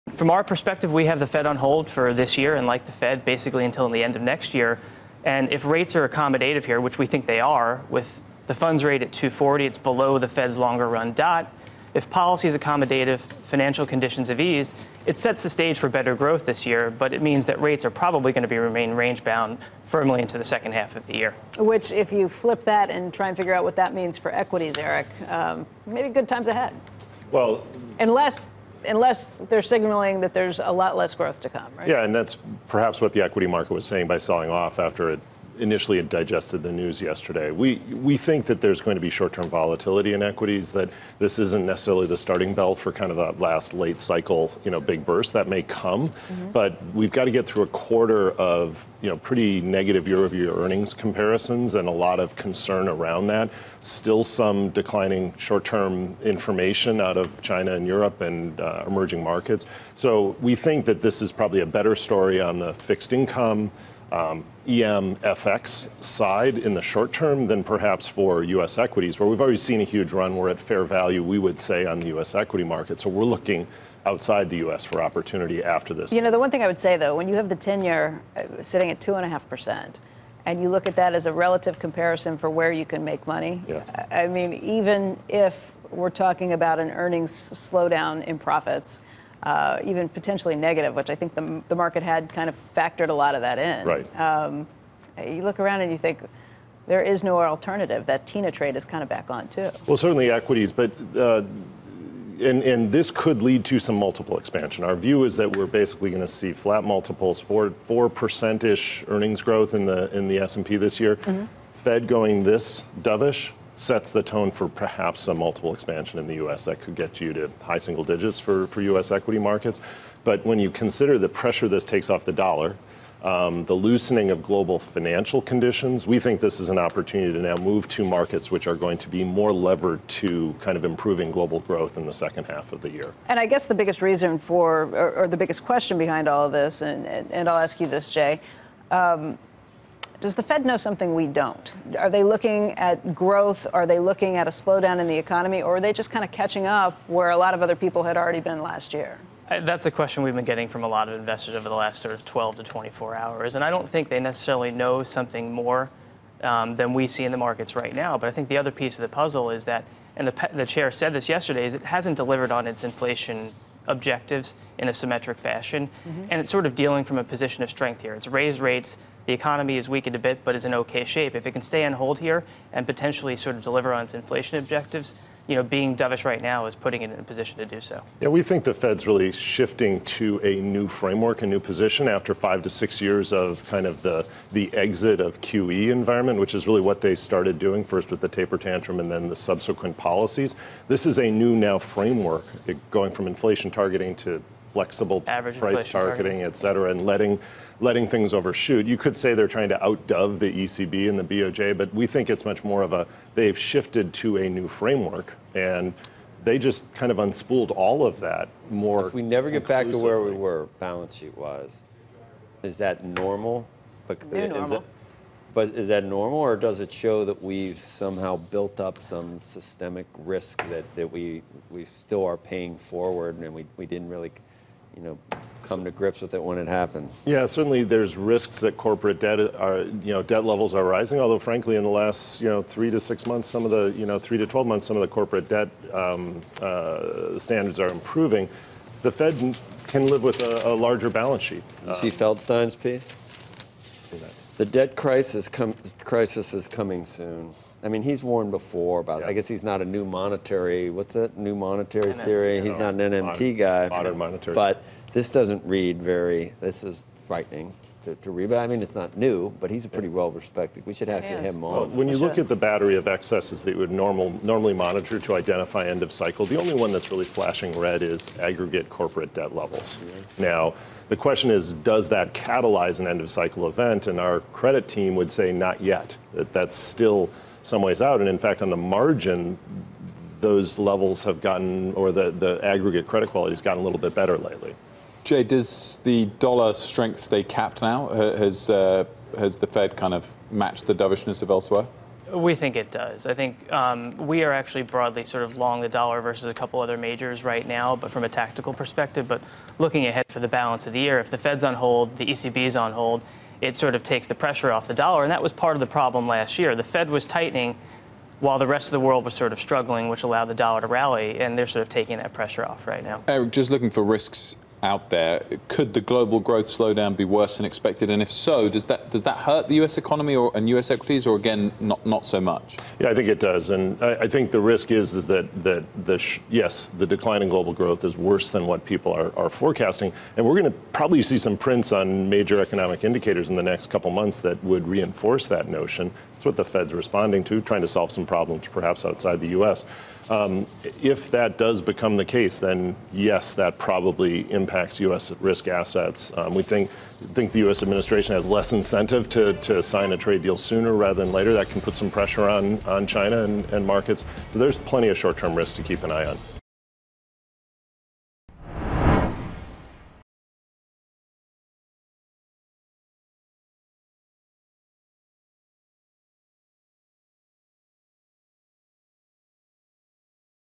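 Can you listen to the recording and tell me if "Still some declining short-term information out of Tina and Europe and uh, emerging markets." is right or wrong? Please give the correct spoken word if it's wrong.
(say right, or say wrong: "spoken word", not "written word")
wrong: "China", not "Tina".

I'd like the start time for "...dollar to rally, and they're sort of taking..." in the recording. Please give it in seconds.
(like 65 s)
310 s.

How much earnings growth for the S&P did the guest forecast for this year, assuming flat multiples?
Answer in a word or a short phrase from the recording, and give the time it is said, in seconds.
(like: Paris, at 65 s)
4%, at 107 s.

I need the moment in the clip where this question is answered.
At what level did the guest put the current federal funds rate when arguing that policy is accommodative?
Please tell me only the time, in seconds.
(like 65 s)
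9 s.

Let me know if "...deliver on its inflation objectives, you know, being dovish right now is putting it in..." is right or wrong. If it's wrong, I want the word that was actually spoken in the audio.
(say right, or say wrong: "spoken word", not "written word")
right.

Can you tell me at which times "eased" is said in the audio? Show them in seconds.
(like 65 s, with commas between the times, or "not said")
14 s.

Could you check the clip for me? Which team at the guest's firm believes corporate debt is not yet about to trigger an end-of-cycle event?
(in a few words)
Credit team.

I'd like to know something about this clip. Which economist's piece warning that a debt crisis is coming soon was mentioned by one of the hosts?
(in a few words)
Feldstein.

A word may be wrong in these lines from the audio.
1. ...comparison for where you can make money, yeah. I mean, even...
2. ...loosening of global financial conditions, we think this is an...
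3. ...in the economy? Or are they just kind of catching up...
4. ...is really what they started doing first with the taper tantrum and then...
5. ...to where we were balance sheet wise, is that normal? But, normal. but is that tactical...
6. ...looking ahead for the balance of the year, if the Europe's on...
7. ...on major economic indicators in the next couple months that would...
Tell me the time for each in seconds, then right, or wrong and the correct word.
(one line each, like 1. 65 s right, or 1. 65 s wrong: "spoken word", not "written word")
1. 81 s right
2. 123 s right
3. 145 s right
4. 186 s right
5. 209 s wrong: "normal", not "tactical"
6. 299 s wrong: "Fed", not "Europe"
7. 331 s right.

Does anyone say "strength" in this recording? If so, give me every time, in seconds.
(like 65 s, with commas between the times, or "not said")
167 s, 286 s.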